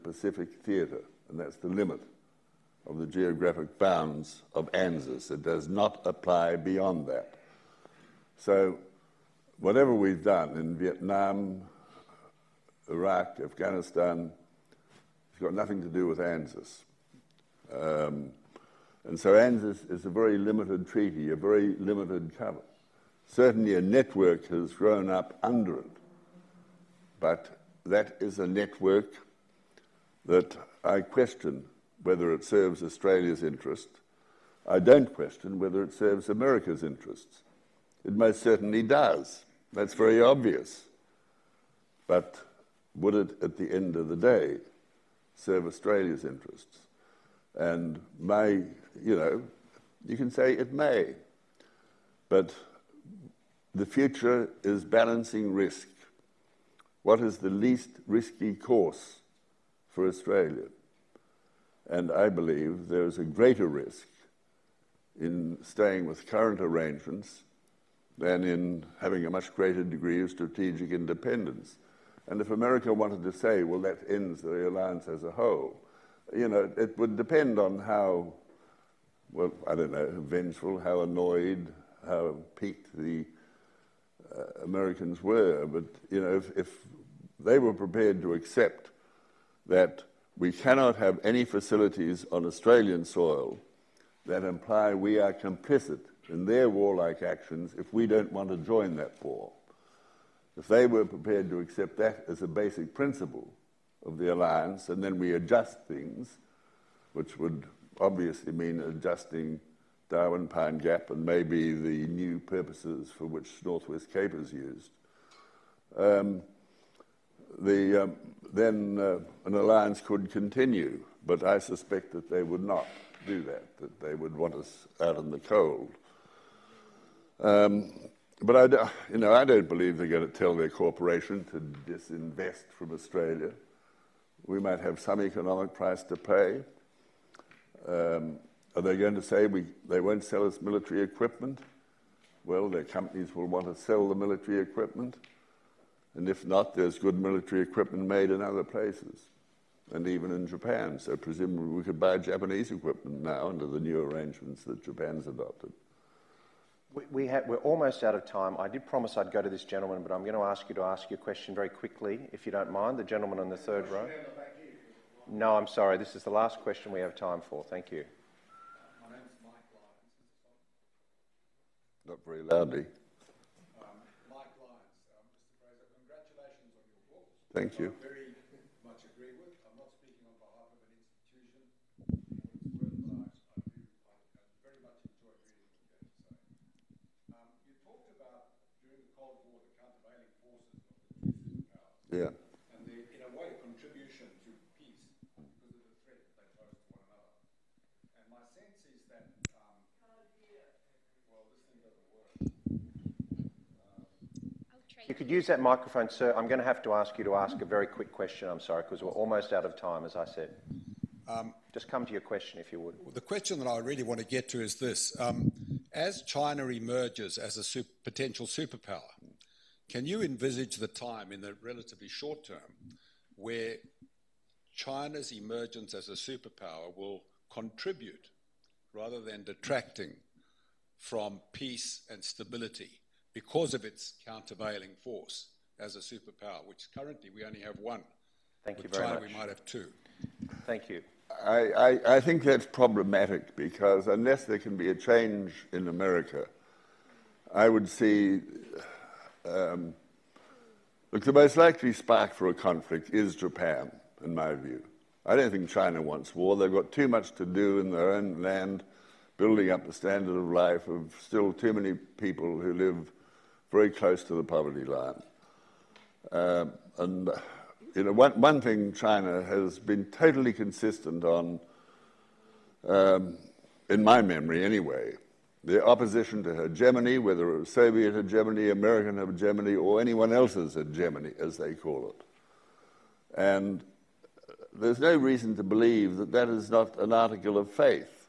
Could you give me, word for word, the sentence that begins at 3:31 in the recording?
Um, Just come to your question, if you would.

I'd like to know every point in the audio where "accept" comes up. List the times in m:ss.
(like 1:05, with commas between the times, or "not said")
1:28, 1:41.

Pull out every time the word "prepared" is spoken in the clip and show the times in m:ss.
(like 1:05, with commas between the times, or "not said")
1:27, 1:41.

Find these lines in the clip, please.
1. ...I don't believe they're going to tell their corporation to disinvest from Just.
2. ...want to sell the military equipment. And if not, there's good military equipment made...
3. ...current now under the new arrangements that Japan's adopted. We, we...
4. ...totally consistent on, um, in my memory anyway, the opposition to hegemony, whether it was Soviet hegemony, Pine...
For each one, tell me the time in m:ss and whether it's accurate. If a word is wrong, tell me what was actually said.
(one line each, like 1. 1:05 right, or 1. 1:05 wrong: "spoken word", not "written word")
1. 2:09 wrong: "Australia", not "Just"
2. 2:23 right
3. 2:32 wrong: "equipment", not "current"
4. 4:30 wrong: "American", not "Pine".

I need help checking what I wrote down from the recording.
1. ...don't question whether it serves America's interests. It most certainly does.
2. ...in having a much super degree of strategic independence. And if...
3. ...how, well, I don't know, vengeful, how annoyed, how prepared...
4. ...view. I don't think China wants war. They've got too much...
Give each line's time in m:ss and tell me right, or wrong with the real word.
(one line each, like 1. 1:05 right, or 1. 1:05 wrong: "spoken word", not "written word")
1. 0:34 right
2. 1:08 wrong: "greater", not "super"
3. 1:17 wrong: "piqued", not "prepared"
4. 4:14 right.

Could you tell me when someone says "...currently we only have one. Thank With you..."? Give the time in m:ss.
3:56.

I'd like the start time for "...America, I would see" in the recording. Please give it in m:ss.
4:05.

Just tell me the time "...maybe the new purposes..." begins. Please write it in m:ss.
1:51.